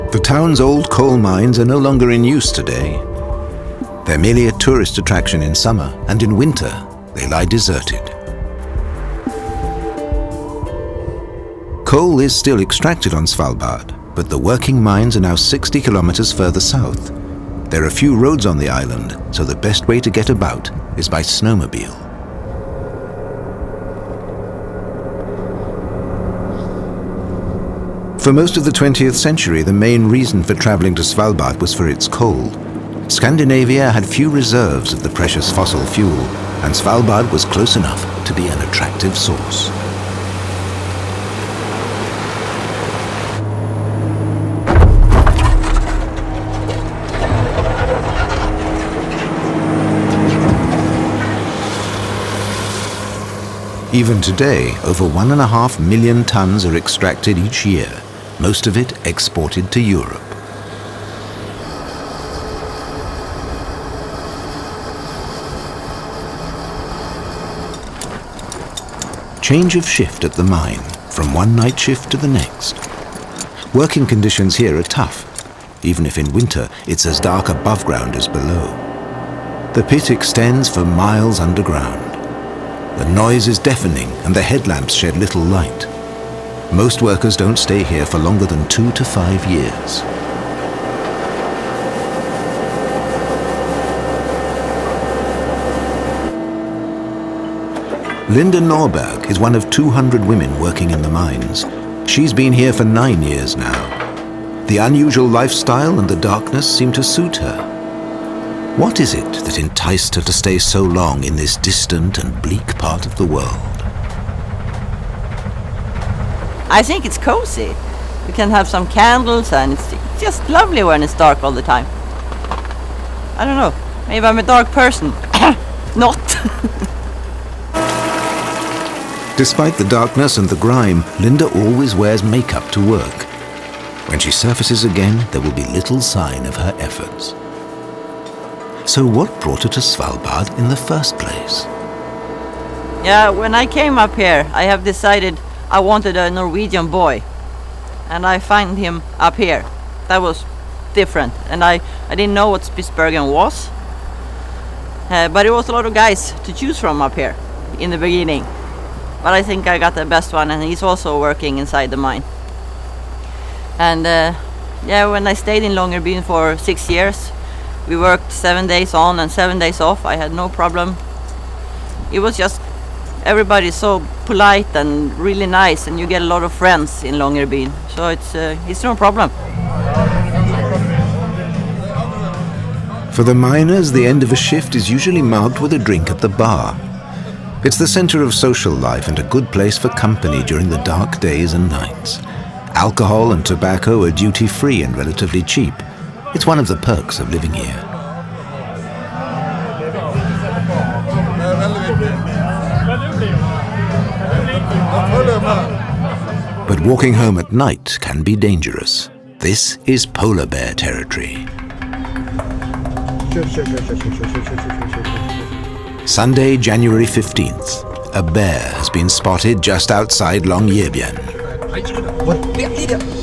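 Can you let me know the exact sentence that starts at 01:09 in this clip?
Change of shift at the mine, from one night shift to the next.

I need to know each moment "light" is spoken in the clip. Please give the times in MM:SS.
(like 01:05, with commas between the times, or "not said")
01:25.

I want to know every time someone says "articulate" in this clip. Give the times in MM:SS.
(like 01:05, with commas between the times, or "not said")
not said.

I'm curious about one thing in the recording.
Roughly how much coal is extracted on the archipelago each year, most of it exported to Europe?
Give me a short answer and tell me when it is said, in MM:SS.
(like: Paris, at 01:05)
1.5 million tons, at 00:55.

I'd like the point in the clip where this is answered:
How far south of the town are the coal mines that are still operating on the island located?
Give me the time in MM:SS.
00:15.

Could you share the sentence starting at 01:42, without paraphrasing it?
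She's been here for nine years now.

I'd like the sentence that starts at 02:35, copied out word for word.
Uh, but it was a lot of guys to choose from up here in the beginning.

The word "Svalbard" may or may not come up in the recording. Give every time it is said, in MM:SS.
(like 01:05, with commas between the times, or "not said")
00:13, 00:31, 00:36, 02:19.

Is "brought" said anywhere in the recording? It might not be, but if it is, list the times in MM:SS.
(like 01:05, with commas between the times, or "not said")
02:19.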